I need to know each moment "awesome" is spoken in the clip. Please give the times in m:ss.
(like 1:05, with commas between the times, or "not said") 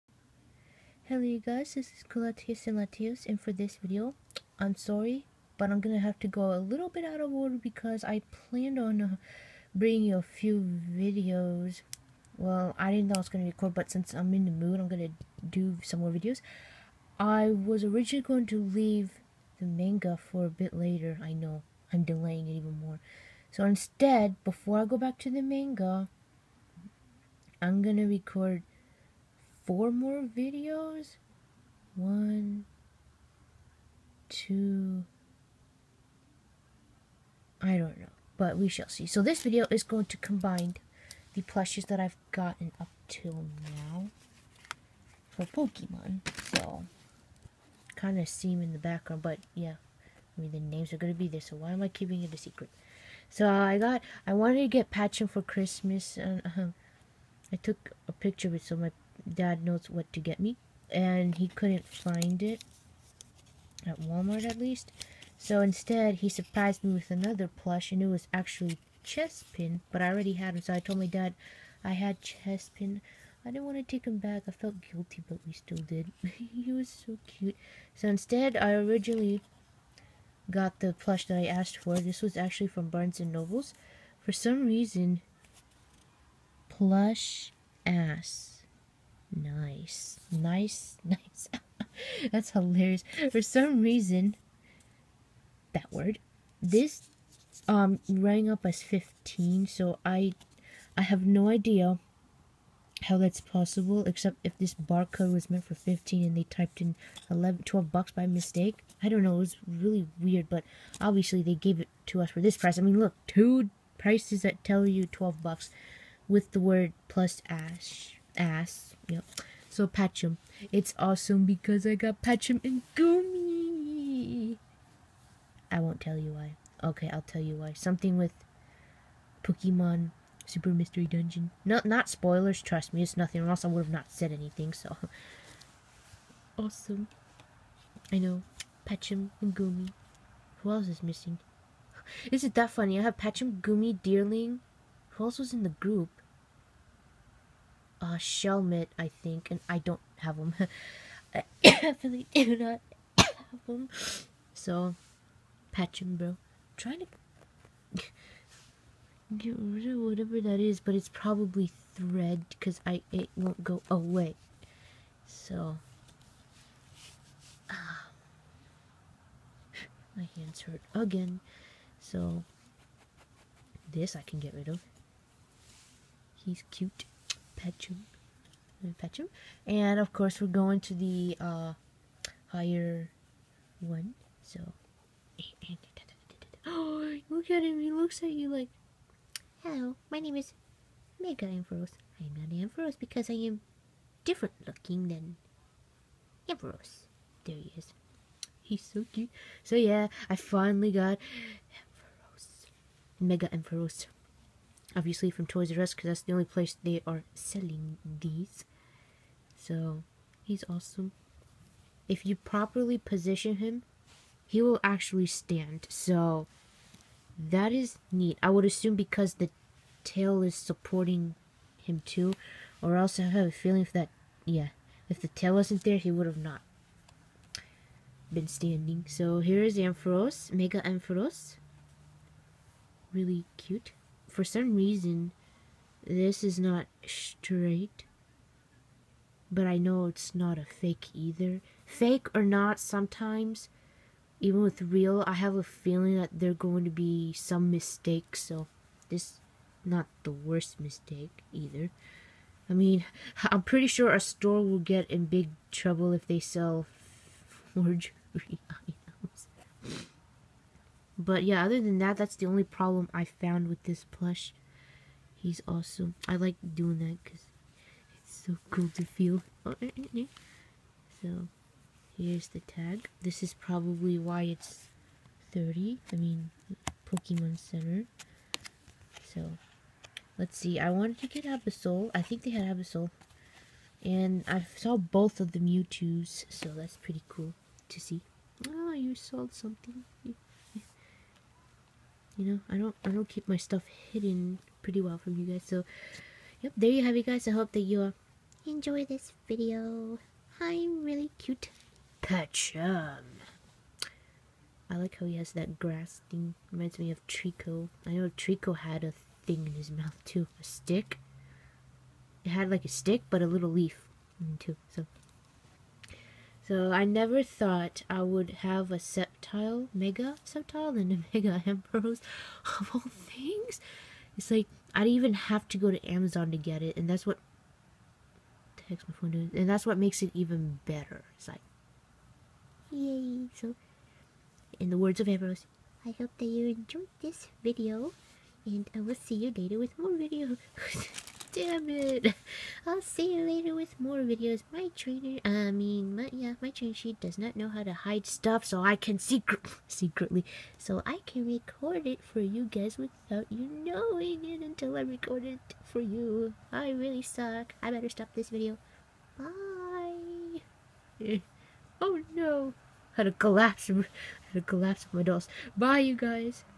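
2:00, 2:16, 3:30, 4:25.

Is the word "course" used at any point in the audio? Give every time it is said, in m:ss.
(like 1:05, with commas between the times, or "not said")
3:00.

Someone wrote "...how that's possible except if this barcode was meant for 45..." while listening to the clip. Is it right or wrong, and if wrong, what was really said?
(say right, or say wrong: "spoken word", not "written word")
wrong: "15", not "45".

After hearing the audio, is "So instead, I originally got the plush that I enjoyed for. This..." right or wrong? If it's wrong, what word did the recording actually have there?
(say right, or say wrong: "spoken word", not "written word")
wrong: "asked", not "enjoyed".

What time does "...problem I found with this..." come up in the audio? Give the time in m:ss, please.
4:22.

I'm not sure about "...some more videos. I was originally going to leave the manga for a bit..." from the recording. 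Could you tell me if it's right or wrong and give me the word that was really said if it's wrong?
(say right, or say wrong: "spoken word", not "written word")
right.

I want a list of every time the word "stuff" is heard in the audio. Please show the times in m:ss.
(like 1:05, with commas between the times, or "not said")
4:53, 5:48.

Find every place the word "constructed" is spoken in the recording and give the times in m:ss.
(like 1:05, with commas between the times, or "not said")
not said.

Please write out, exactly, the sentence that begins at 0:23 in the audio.
So instead, before I go back to the manga, I'm gonna record four more videos.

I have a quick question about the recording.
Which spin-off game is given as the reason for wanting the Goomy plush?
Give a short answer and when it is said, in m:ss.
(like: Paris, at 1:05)
Pokemon Super Mystery Dungeon, at 2:09.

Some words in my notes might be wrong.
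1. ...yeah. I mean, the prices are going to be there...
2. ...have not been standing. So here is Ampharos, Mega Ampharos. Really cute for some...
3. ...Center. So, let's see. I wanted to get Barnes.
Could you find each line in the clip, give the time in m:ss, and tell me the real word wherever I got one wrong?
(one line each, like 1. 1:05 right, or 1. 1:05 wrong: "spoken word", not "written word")
1. 0:49 wrong: "names", not "prices"
2. 3:46 right
3. 4:37 wrong: "Absol", not "Barnes".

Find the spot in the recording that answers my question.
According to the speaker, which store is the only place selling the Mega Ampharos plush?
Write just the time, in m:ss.
3:25.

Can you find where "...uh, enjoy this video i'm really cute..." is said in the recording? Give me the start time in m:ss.
4:58.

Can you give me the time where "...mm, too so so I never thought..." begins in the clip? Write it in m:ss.
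5:14.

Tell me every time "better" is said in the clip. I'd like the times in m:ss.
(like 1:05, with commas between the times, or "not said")
5:30, 5:57.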